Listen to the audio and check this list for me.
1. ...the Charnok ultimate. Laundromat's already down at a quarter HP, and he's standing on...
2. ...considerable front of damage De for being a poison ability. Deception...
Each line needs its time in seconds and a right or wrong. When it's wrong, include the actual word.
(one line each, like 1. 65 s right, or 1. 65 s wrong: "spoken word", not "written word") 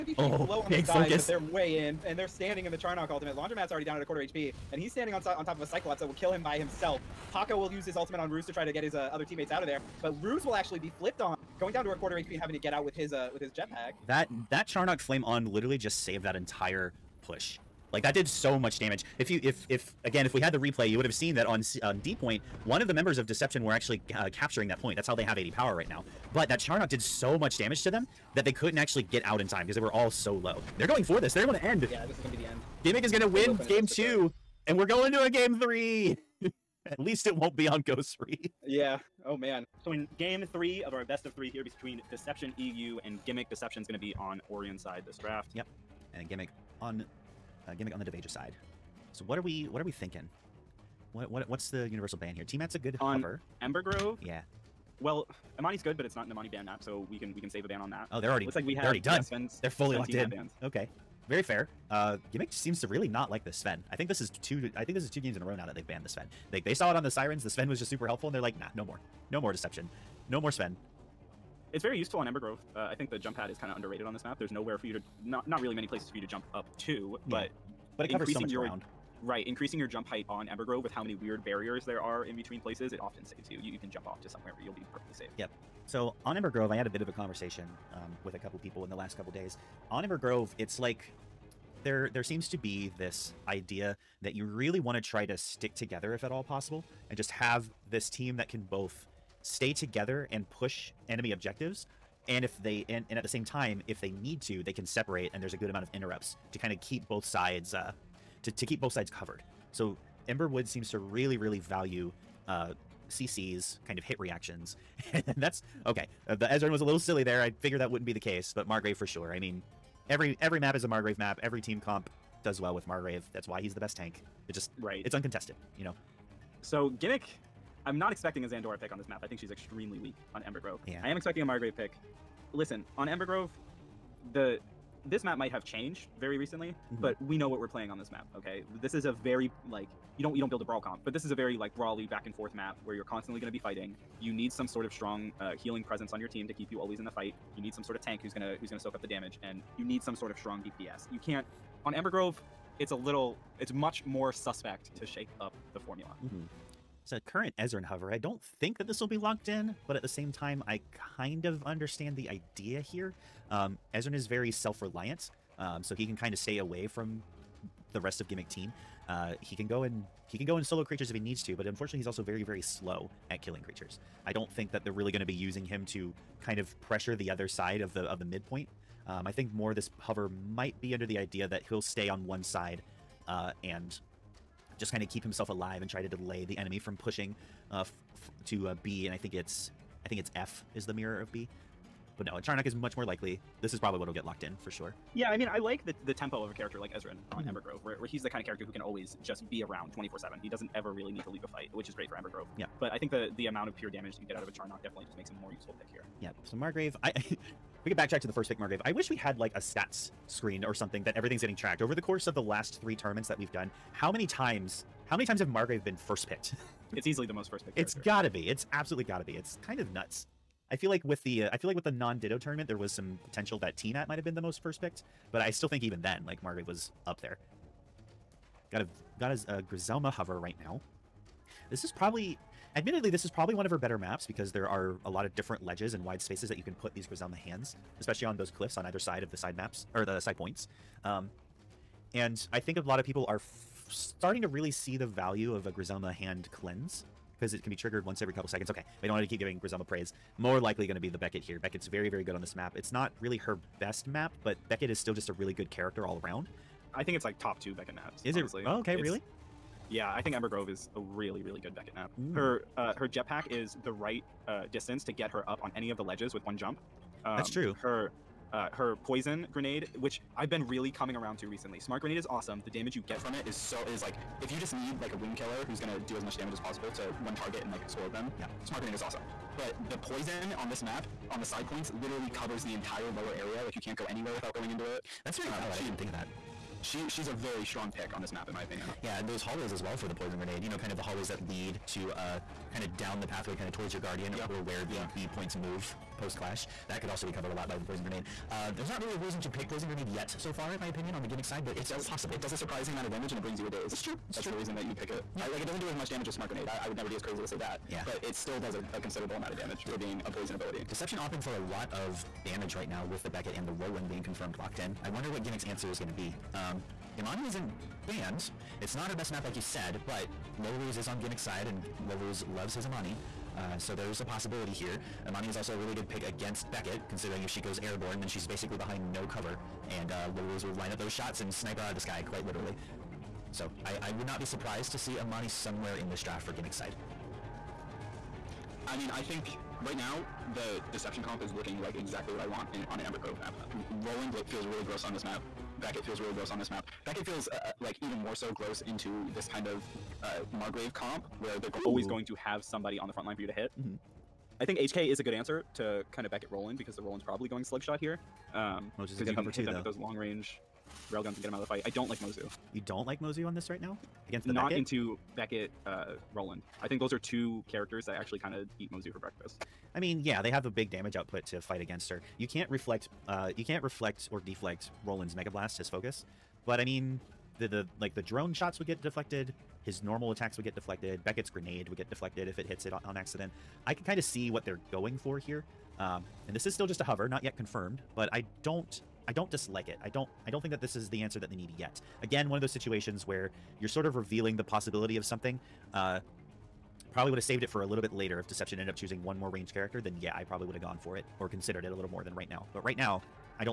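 1. 2 s right
2. 308 s wrong: "amount", not "front".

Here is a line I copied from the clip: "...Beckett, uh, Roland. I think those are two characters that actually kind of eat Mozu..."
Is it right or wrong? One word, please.
right.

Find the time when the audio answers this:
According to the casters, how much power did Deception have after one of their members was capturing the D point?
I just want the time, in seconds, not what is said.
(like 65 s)
25 s.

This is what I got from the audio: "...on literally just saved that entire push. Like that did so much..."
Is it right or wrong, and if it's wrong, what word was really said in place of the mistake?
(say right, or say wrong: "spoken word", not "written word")
right.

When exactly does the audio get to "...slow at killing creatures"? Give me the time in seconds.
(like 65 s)
172 s.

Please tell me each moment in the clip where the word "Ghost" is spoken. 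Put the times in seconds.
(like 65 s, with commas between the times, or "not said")
37 s.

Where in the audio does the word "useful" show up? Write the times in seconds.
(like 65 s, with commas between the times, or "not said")
71 s, 205 s.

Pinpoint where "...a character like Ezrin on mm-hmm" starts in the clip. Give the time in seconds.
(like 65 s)
196 s.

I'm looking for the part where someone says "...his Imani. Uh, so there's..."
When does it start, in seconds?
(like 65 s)
322 s.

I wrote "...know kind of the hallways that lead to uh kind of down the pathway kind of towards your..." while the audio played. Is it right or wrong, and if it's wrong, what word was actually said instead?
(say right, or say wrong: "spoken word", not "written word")
right.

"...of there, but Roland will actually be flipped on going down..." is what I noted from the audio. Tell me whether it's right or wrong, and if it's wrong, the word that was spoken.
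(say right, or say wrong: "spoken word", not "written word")
wrong: "Ruse", not "Roland".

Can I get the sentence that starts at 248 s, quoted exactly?
Okay, we don't want to keep giving Griselma praise.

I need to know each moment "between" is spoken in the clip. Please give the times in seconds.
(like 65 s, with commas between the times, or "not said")
41 s, 82 s.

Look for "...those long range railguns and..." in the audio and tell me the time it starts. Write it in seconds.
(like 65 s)
359 s.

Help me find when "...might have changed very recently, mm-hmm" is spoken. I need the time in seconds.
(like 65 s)
135 s.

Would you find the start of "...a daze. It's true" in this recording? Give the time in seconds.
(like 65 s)
303 s.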